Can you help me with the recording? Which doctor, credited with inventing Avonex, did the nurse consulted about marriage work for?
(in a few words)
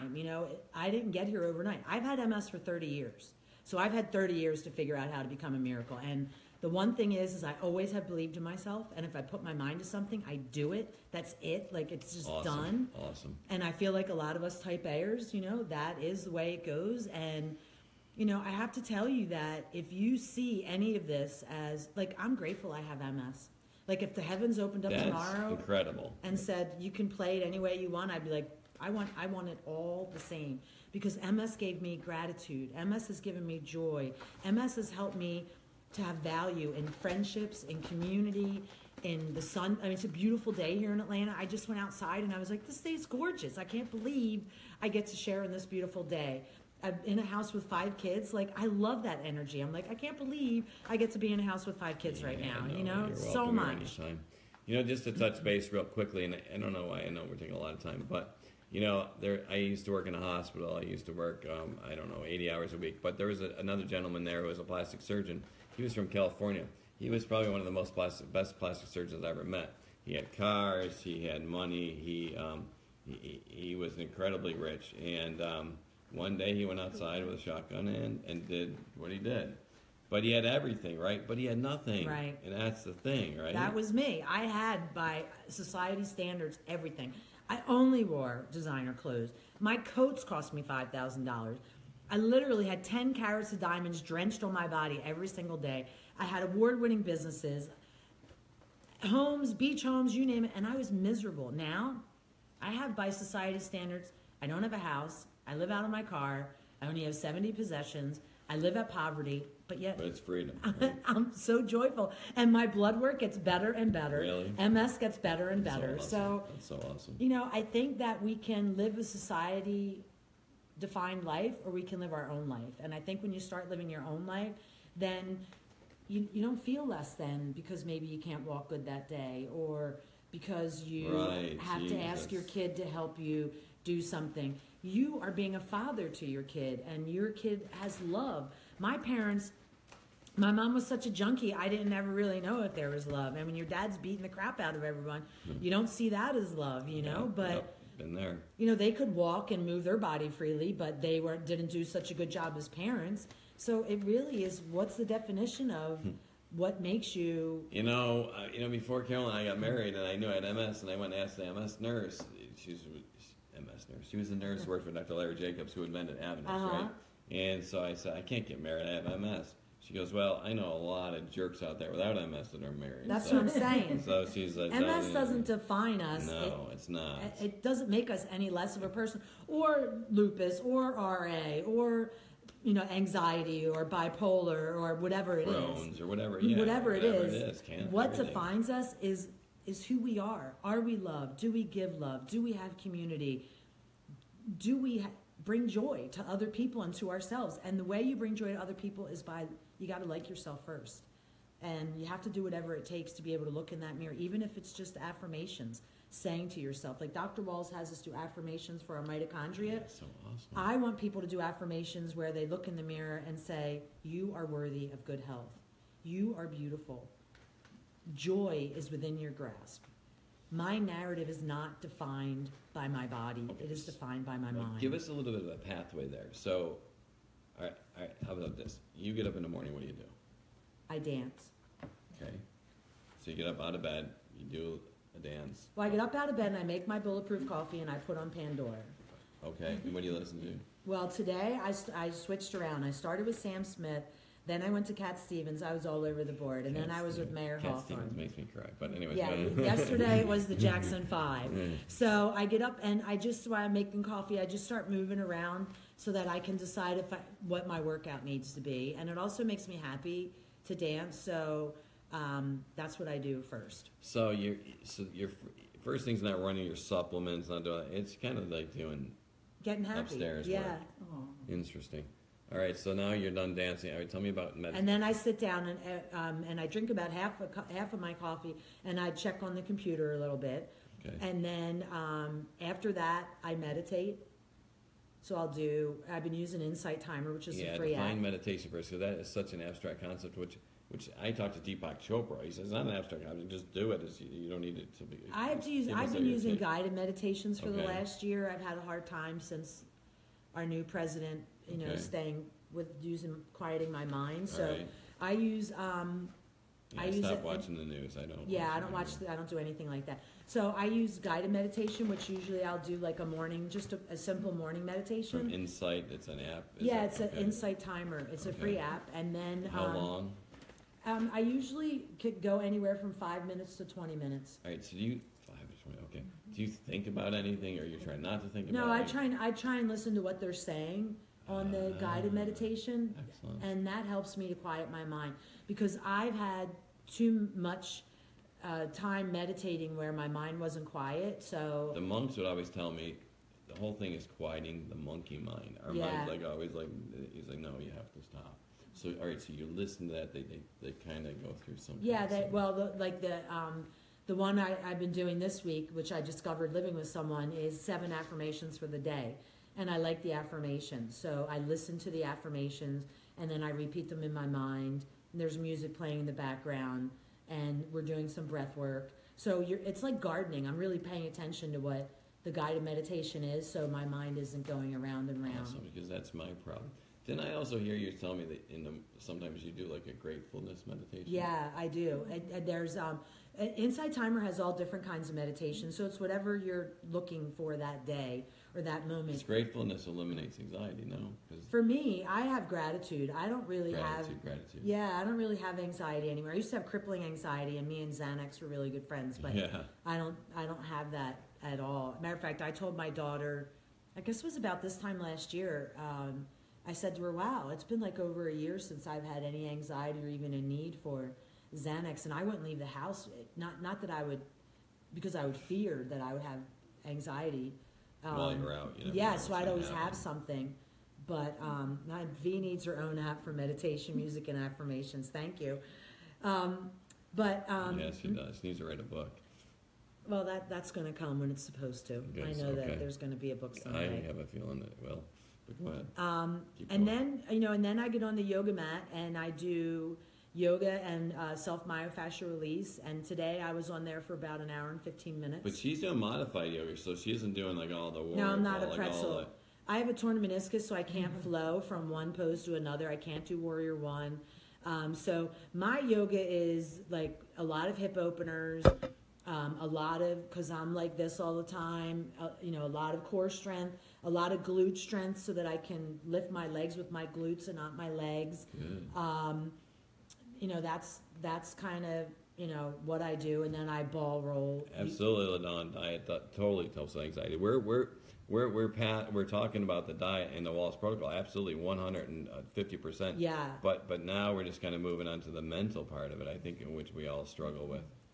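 Dr. Larry Jacobs.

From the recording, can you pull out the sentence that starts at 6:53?
Not not that I would, because I would fear that I would have anxiety um, While you're out, you know, yeah.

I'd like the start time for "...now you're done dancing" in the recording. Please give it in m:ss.
4:32.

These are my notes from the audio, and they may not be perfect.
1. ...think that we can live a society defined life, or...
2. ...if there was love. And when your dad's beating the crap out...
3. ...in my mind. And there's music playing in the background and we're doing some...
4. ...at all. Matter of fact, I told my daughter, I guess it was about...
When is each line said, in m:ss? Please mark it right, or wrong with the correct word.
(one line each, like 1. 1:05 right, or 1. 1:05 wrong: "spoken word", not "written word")
1. 1:57 right
2. 2:22 right
3. 6:04 right
4. 6:41 right.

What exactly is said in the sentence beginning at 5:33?
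and that helps me to quiet my mind because I've had too much uh, time meditating where my mind wasn't quiet.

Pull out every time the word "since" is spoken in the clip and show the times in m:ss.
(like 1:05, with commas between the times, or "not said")
4:59, 6:48.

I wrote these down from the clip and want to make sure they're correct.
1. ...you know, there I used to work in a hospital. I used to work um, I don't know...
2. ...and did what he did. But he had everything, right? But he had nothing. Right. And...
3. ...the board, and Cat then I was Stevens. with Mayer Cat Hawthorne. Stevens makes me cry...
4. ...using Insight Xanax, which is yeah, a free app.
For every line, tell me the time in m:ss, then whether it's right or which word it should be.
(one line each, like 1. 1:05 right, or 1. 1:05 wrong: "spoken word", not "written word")
1. 0:58 right
2. 1:18 right
3. 4:06 right
4. 4:46 wrong: "Timer", not "Xanax".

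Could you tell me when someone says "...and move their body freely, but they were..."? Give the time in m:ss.
2:29.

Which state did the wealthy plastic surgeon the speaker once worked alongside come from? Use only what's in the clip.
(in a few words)
California.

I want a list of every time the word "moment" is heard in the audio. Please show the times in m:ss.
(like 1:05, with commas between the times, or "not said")
6:29.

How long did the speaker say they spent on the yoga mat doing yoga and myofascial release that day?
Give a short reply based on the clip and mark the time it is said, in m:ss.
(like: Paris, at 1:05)
1 hour 15 minutes, at 7:24.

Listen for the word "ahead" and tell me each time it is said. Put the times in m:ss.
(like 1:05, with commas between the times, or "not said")
7:15.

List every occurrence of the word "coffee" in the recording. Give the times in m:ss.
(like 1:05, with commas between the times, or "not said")
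3:57, 4:14, 4:38.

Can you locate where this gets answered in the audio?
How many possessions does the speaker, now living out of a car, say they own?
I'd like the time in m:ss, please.
1:47.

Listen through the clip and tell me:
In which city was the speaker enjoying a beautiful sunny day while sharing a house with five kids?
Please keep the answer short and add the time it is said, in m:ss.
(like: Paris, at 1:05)
Atlanta, at 0:40.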